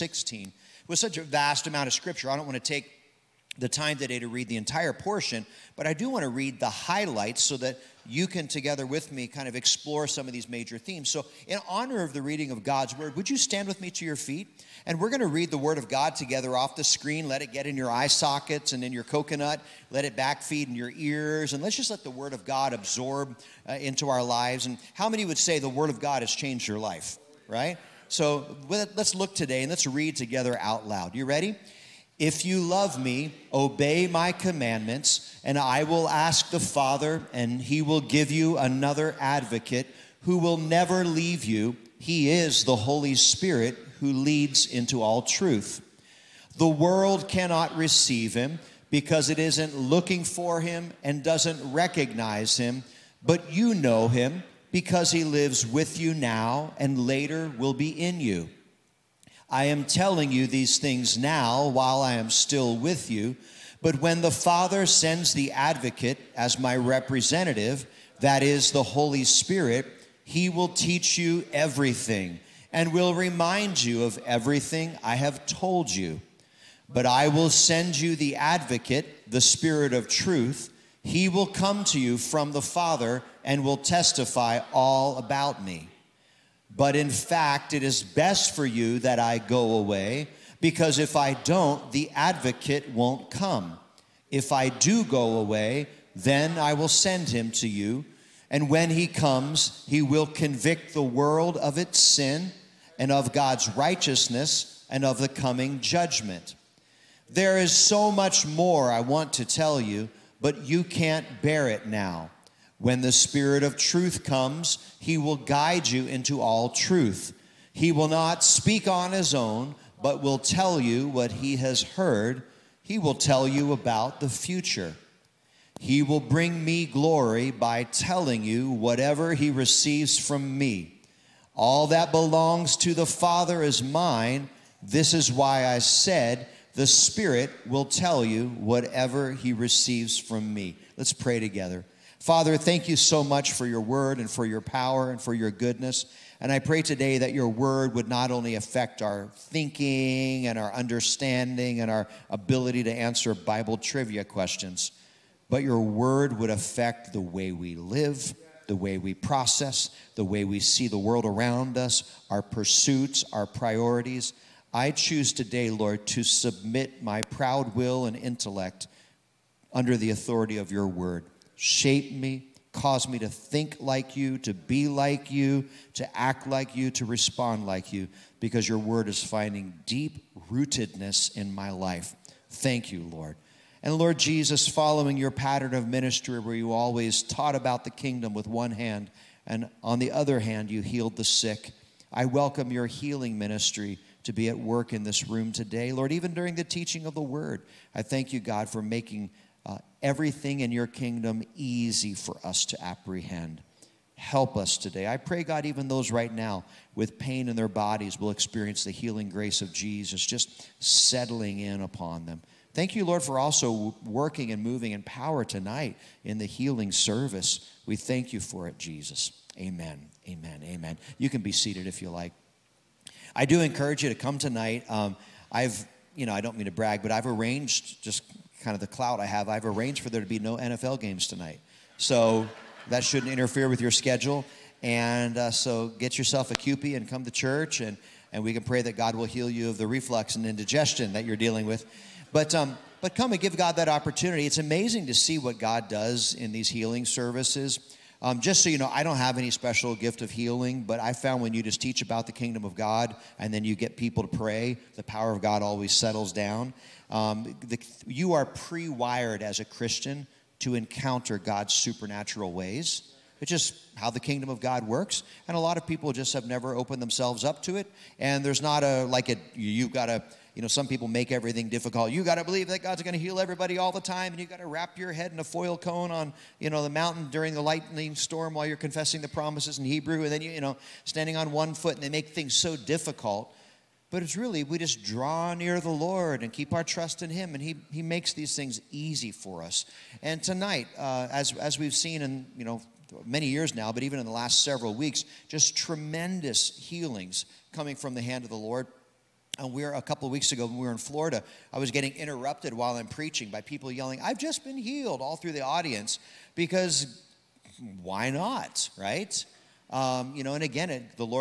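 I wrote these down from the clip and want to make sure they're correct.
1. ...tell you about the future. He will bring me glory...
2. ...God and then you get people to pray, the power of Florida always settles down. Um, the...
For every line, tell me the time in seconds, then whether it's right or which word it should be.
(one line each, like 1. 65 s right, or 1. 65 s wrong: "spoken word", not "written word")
1. 123 s right
2. 252 s wrong: "God", not "Florida".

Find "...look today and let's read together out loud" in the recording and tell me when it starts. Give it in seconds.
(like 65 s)
29 s.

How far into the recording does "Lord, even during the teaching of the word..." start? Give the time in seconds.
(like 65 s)
195 s.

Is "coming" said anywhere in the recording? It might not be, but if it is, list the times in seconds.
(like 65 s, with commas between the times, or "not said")
105 s, 297 s.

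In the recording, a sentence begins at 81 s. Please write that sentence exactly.
He will come to you from the Father and will testify all about me.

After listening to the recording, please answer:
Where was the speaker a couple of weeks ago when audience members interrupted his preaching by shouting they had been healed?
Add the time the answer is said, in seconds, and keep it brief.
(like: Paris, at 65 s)
Florida, at 300 s.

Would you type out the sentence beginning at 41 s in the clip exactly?
He is the Holy Spirit who leads into all truth.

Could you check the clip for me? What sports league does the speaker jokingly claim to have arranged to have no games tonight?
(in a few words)
NFL.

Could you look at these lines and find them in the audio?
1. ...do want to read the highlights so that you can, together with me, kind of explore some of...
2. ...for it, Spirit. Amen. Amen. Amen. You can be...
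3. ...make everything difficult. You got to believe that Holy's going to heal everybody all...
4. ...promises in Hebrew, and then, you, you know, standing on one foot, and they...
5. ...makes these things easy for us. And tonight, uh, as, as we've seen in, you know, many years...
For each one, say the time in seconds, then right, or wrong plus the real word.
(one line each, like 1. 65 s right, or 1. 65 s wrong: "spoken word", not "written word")
1. 5 s right
2. 218 s wrong: "Jesus", not "Spirit"
3. 271 s wrong: "God", not "Holy"
4. 279 s right
5. 288 s right.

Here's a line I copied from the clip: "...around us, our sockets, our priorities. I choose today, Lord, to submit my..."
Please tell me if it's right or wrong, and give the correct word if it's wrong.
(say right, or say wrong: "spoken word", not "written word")
wrong: "pursuits", not "sockets".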